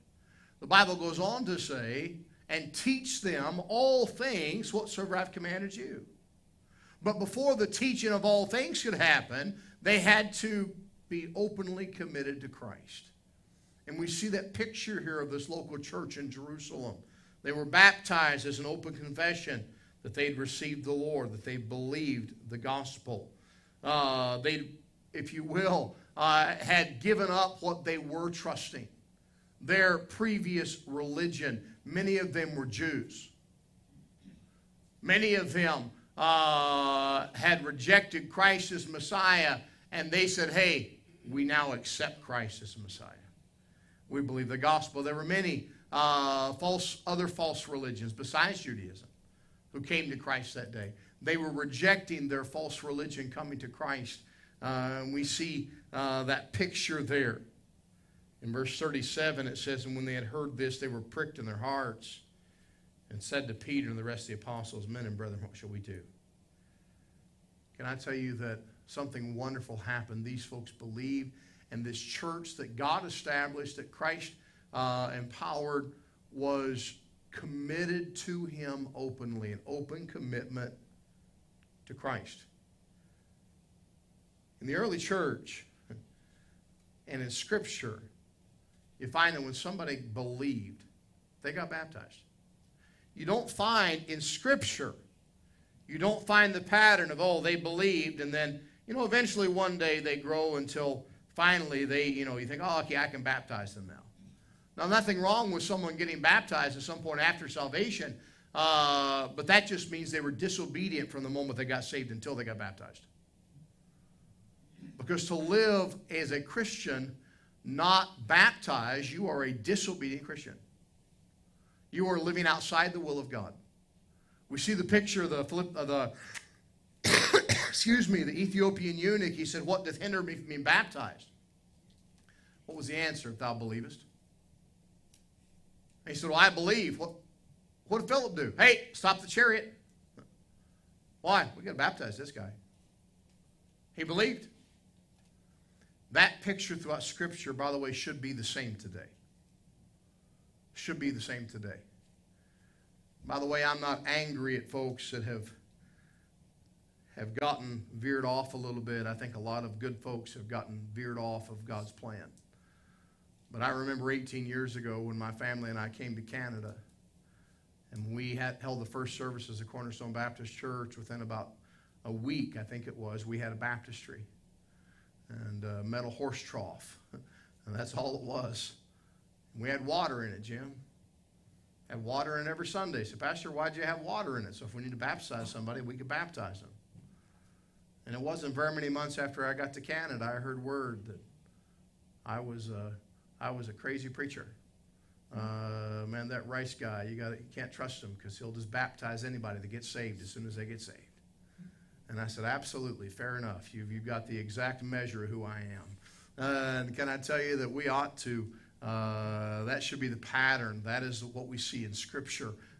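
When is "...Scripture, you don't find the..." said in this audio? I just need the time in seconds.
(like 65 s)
94 s.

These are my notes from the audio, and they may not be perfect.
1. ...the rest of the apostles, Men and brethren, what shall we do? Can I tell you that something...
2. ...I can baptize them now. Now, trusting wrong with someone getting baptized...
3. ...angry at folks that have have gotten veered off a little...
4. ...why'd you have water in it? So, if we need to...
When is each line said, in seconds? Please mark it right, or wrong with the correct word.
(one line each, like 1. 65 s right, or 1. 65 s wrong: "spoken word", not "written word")
1. 63 s right
2. 102 s wrong: "nothing", not "trusting"
3. 154 s right
4. 183 s right.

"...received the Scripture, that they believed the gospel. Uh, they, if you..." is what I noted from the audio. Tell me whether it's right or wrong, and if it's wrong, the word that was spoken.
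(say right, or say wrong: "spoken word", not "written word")
wrong: "Lord", not "Scripture".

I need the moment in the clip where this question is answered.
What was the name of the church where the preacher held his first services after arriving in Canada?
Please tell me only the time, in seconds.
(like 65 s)
169 s.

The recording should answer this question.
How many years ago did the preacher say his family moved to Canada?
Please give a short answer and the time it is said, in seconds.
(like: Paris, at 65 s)
18, at 164 s.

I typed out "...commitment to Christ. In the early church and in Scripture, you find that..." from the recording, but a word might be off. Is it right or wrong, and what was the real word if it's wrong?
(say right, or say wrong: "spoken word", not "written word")
right.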